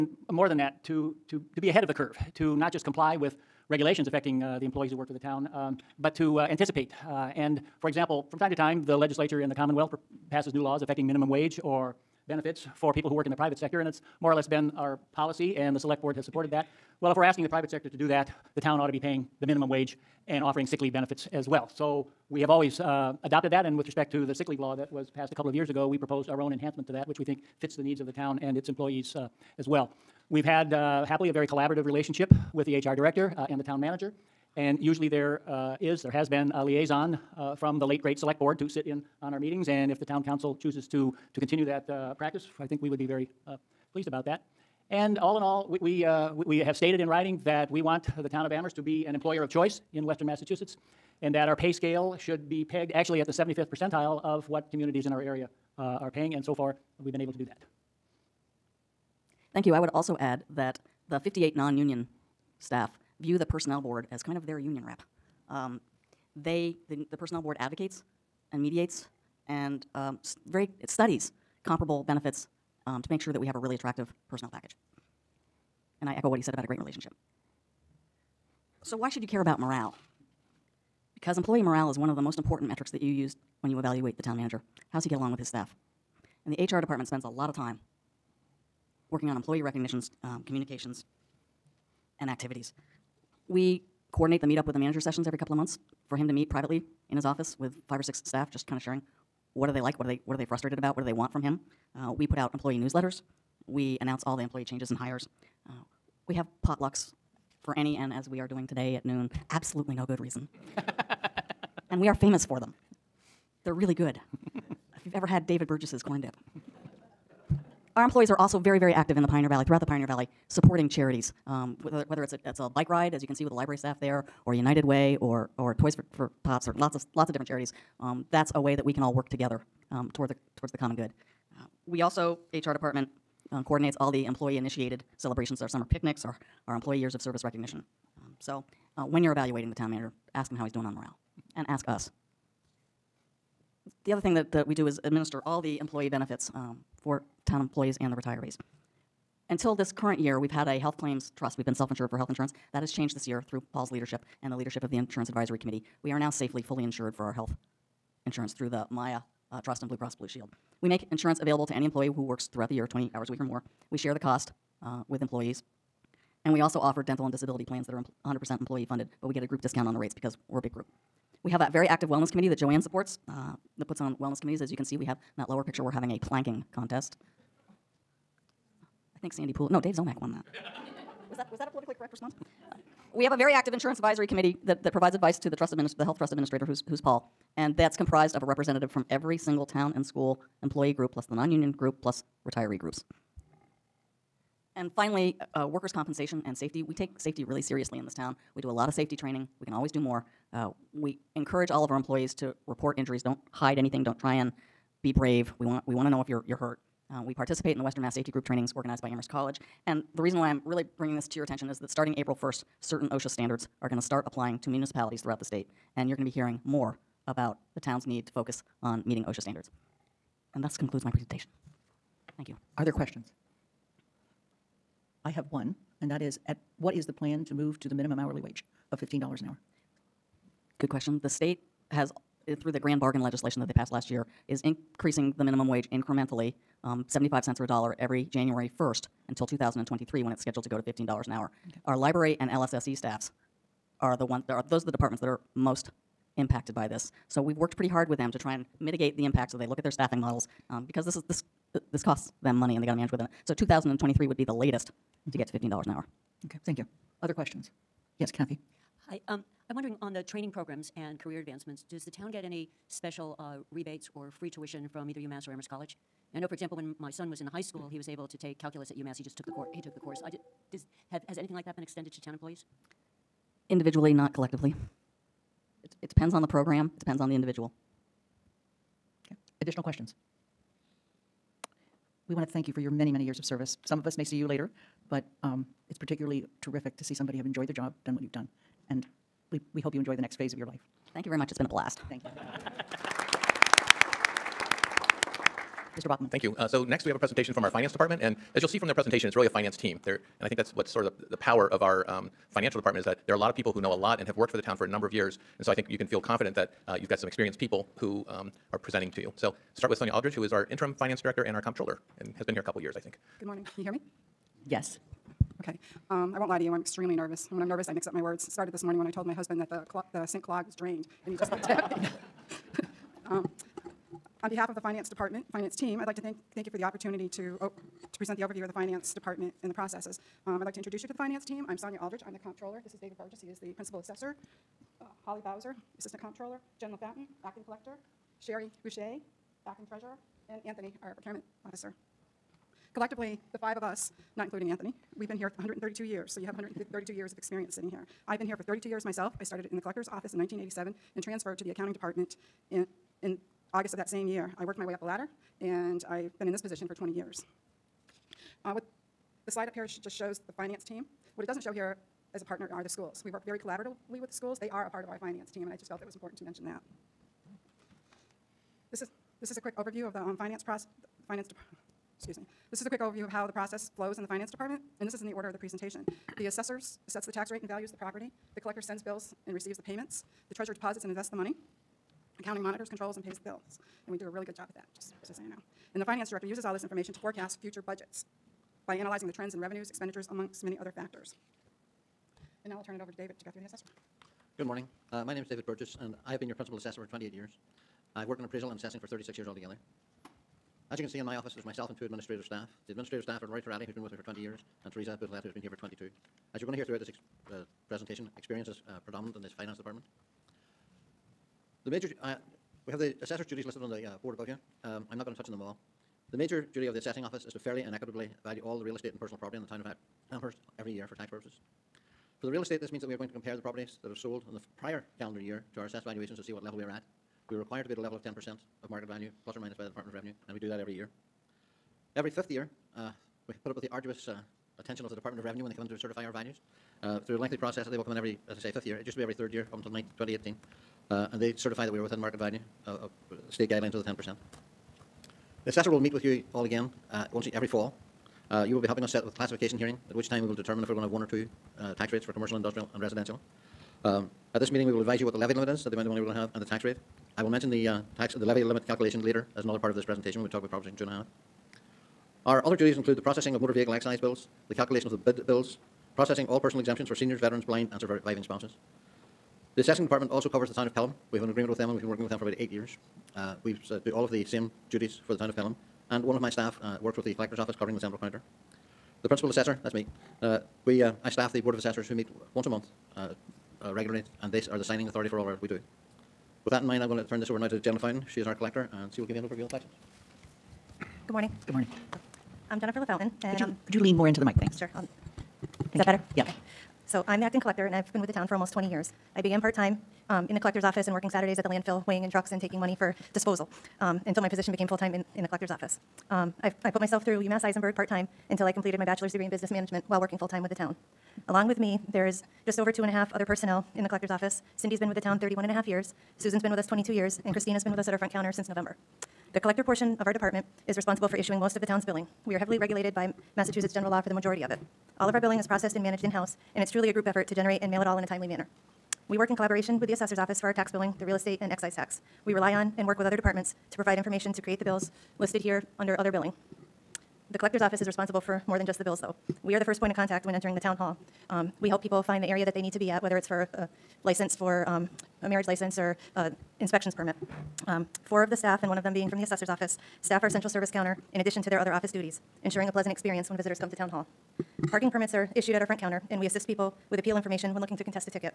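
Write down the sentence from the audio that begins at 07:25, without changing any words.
The assessor will meet with you all again uh, once every fall.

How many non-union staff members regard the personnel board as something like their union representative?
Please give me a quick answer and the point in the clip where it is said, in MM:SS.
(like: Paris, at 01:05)
58, at 01:01.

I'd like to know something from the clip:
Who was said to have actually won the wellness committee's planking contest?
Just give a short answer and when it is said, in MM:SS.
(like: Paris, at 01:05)
Dave Ziomek, at 02:59.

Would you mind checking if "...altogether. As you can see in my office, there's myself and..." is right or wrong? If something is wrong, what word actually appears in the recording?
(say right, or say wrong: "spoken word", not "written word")
right.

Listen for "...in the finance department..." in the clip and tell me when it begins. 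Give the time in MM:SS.
06:14.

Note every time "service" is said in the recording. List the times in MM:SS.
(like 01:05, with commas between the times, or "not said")
02:17, 04:43, 09:10.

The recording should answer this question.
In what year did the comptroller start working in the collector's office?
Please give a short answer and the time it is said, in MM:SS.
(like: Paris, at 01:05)
1987, at 05:50.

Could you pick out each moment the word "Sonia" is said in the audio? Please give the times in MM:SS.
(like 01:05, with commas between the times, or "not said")
05:09, 05:31.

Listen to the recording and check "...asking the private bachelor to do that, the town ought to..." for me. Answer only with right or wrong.
wrong.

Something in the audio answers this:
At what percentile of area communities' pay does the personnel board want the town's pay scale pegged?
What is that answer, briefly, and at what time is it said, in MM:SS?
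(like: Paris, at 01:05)
75th percentile, at 00:53.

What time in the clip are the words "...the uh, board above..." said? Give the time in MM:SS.
06:53.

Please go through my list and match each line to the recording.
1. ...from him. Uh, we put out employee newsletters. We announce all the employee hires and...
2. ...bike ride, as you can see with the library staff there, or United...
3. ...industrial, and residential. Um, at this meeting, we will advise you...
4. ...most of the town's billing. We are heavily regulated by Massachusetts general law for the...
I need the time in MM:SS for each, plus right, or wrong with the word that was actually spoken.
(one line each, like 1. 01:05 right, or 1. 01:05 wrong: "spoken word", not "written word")
1. 01:41 wrong: "changes", not "hires"
2. 02:02 right
3. 07:32 right
4. 08:41 right.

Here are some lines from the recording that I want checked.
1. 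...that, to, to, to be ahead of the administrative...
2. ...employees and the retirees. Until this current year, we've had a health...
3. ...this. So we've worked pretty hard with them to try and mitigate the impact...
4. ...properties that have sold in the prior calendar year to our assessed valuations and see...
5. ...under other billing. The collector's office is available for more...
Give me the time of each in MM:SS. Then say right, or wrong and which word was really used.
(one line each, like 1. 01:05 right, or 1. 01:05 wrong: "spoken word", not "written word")
1. 00:00 wrong: "curve", not "administrative"
2. 02:27 right
3. 04:06 right
4. 07:03 right
5. 08:55 wrong: "responsible", not "available".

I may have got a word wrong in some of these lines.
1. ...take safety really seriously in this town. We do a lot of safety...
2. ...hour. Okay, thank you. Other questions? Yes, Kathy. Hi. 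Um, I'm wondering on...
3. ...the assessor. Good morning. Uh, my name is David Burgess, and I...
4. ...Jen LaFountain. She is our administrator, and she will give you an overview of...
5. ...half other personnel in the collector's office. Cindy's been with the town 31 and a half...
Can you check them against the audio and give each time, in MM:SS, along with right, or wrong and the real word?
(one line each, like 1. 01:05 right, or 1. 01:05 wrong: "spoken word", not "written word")
1. 03:16 right
2. 04:15 right
3. 06:33 right
4. 08:07 wrong: "collector", not "administrator"
5. 08:33 right.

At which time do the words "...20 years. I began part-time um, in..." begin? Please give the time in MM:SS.
08:18.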